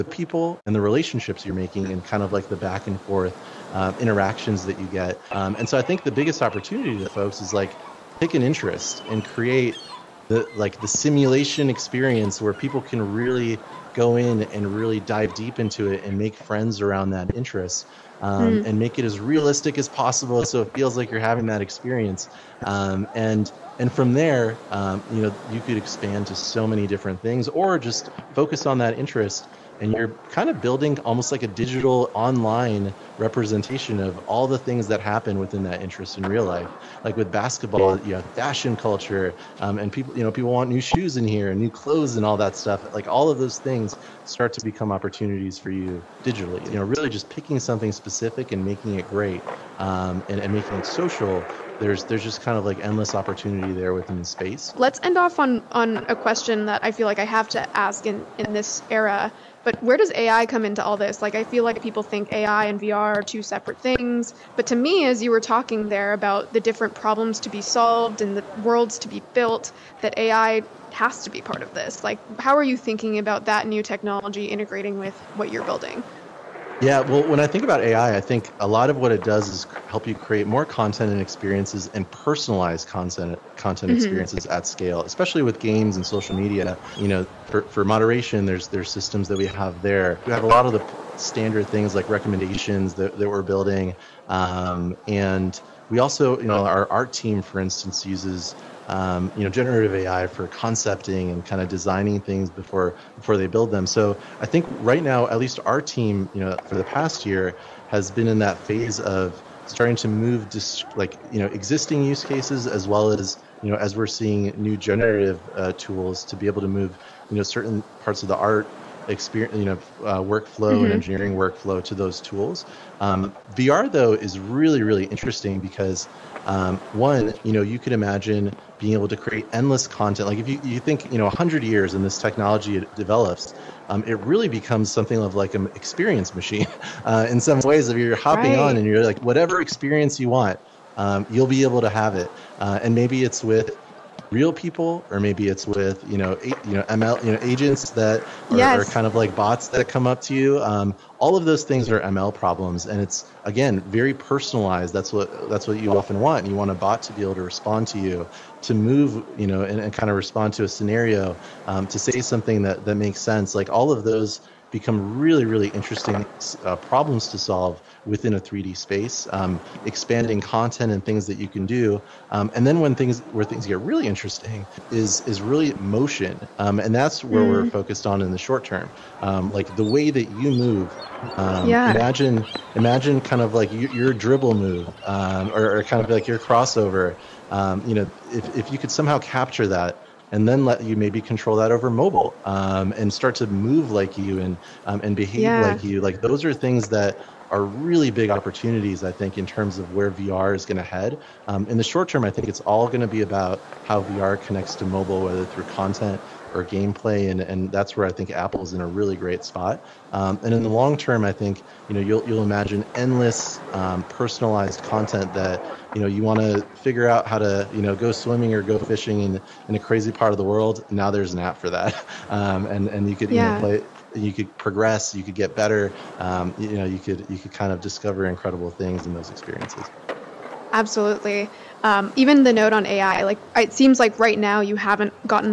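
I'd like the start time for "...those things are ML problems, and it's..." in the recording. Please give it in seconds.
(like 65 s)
151 s.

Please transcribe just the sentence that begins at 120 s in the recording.
and engineering workflow to those tools.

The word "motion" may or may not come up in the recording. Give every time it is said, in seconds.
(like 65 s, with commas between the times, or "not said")
175 s.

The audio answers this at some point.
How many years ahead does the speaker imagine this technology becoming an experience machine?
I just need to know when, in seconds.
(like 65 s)
131 s.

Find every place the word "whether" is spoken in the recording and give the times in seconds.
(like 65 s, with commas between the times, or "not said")
205 s.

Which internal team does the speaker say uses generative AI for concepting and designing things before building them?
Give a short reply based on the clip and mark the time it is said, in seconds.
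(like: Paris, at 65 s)
Art team, at 96 s.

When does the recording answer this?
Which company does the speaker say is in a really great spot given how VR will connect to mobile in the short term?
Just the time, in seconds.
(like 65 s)
208 s.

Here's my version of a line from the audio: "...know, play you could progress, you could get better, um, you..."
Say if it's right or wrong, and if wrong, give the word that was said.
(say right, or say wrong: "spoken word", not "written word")
right.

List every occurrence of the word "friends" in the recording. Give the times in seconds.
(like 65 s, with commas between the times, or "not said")
16 s.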